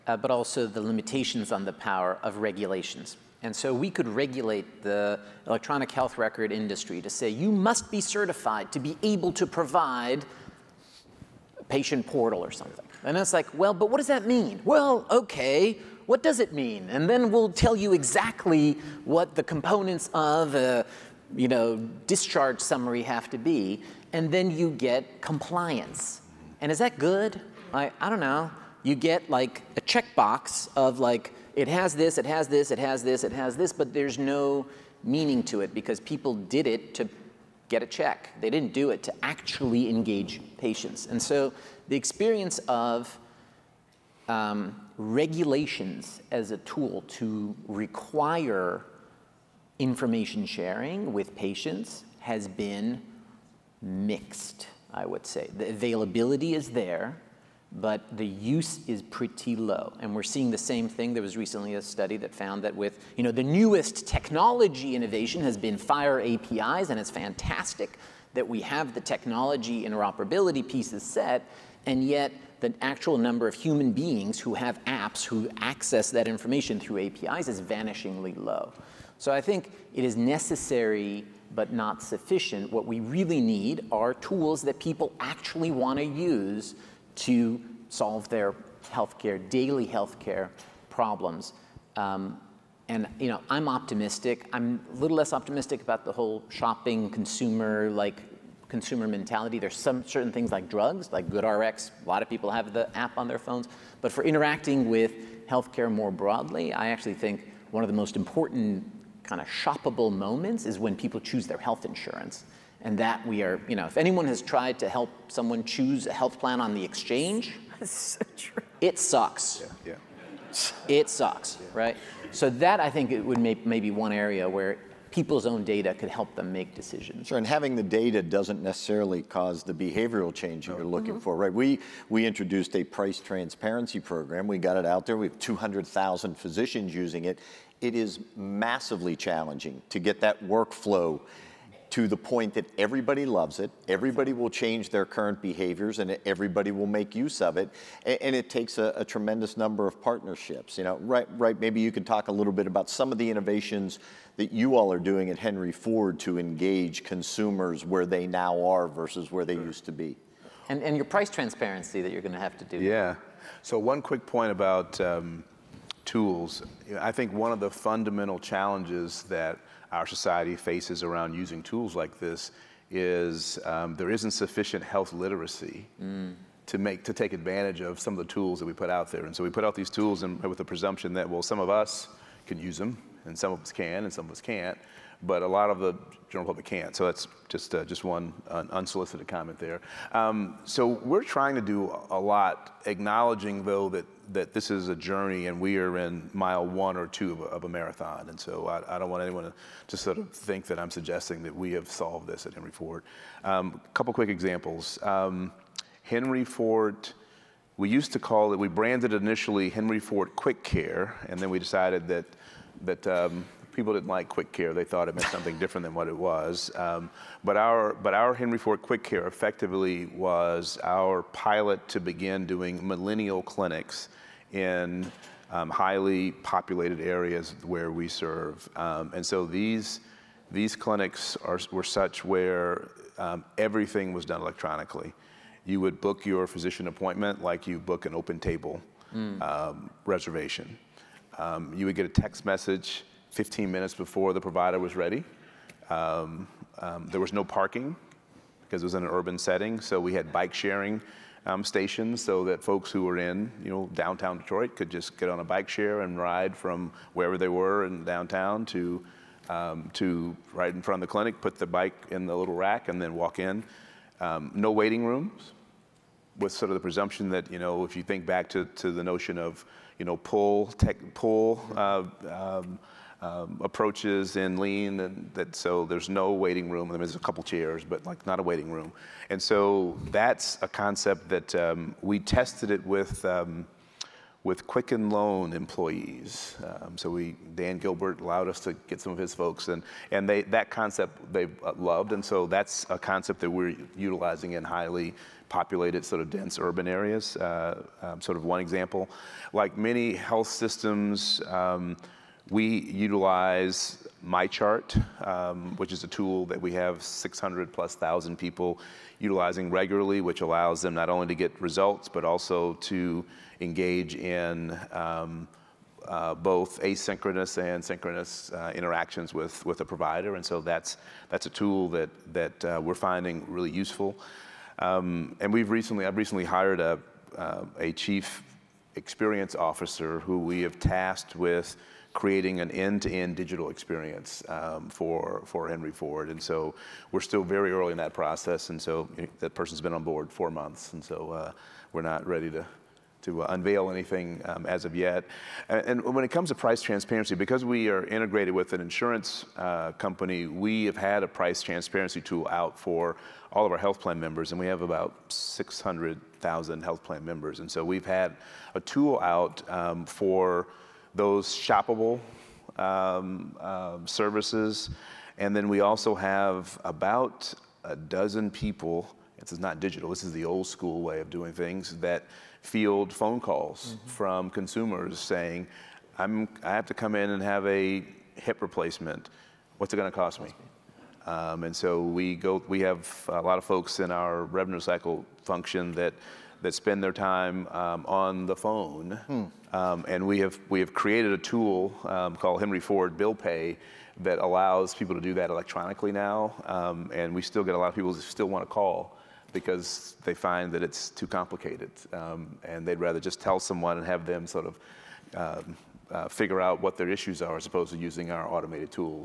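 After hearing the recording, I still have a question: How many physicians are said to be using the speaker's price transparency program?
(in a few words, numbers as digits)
200,000.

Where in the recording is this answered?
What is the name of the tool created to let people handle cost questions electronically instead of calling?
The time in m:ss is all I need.
6:32.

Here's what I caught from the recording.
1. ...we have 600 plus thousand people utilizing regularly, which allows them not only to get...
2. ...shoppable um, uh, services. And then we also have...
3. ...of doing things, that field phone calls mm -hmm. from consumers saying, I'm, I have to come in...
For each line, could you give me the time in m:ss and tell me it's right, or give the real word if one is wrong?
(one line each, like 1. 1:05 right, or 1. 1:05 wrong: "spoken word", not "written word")
1. 5:06 right
2. 6:01 right
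3. 6:11 right.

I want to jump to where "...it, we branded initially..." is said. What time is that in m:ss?
3:28.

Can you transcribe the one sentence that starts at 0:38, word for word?
They didn't do it to actually engage patients.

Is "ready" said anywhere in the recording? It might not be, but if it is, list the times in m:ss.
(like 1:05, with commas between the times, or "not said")
4:04, 5:42.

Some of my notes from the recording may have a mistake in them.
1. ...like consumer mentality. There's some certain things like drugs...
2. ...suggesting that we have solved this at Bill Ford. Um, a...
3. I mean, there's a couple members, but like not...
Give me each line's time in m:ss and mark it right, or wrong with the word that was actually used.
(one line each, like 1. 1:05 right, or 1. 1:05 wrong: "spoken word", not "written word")
1. 1:37 right
2. 3:20 wrong: "Henry", not "Bill"
3. 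4:36 wrong: "chairs", not "members".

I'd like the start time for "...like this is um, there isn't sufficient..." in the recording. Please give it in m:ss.
2:51.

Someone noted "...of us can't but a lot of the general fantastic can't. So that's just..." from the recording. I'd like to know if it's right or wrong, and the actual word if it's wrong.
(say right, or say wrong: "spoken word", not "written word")
wrong: "public", not "fantastic".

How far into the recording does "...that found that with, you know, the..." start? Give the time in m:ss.
1:02.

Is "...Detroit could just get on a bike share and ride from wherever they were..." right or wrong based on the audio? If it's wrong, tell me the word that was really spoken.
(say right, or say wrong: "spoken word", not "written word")
right.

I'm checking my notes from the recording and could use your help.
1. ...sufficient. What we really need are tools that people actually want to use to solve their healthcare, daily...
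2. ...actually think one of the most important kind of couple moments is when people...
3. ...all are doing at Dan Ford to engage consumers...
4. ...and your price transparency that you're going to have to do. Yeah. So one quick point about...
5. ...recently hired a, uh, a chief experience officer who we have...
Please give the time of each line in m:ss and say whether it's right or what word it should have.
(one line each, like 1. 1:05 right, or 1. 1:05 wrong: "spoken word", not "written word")
1. 1:22 right
2. 1:46 wrong: "shoppable", not "couple"
3. 2:34 wrong: "Henry", not "Dan"
4. 2:40 right
5. 5:26 right.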